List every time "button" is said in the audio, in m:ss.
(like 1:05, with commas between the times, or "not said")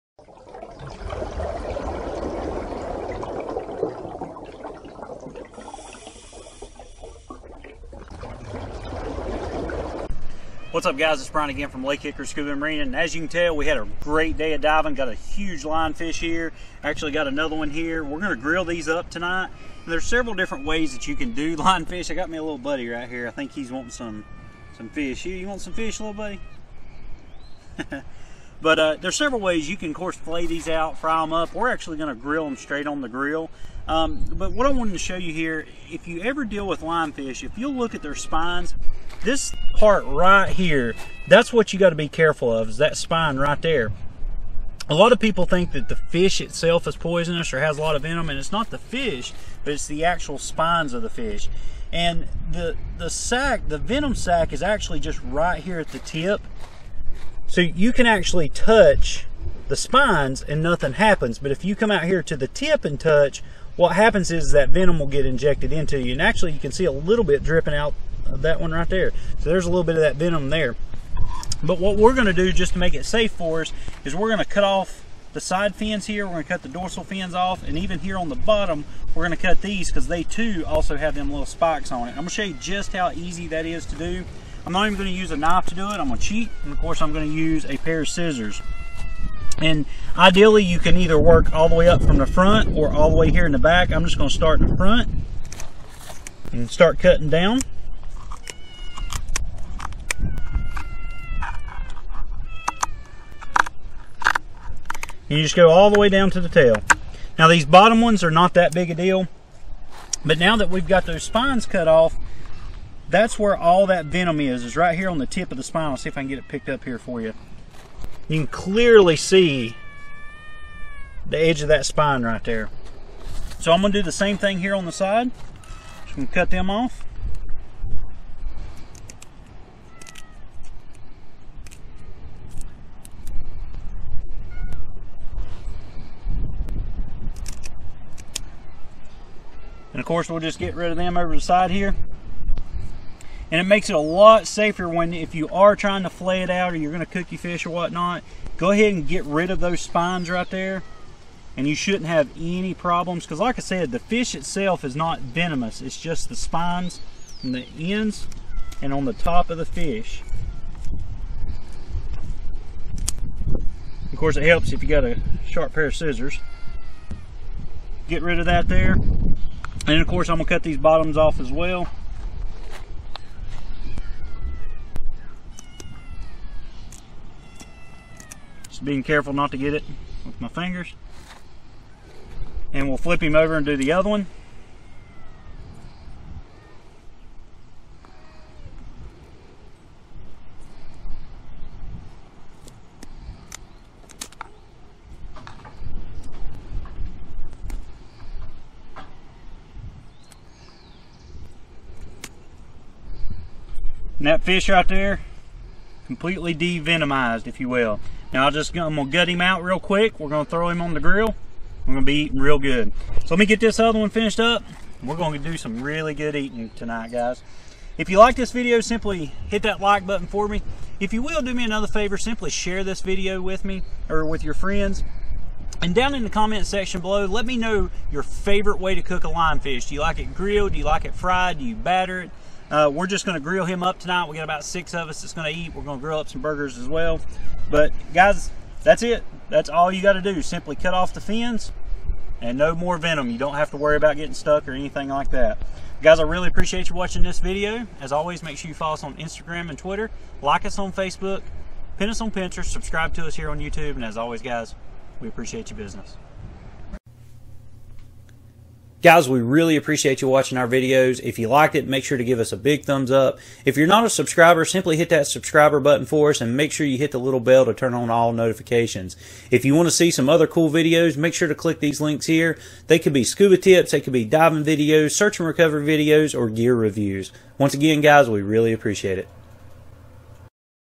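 3:40, 4:25.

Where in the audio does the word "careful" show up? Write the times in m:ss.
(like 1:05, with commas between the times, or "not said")
0:42, 2:59.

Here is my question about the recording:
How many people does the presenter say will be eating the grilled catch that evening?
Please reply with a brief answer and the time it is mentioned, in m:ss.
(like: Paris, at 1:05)
6, at 3:54.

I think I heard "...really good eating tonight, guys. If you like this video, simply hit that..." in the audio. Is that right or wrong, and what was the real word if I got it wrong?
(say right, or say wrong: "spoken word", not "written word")
right.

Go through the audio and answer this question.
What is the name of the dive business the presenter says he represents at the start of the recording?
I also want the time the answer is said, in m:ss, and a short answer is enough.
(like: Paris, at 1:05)
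Lake Hickory Scuba Marina, at 0:11.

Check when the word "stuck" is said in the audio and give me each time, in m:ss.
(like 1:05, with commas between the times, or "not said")
4:04.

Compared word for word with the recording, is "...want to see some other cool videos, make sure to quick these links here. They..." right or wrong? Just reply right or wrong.
wrong.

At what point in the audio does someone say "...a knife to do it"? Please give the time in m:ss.
1:25.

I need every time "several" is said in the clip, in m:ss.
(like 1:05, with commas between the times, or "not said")
0:20, 0:29.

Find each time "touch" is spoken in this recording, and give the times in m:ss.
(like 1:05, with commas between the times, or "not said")
0:58, 1:02.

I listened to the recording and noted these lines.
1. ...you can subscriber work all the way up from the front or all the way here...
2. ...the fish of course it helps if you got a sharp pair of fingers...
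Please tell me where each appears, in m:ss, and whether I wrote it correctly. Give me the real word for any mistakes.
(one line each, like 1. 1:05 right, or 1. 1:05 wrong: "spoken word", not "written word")
1. 1:30 wrong: "either", not "subscriber"
2. 2:39 wrong: "scissors", not "fingers".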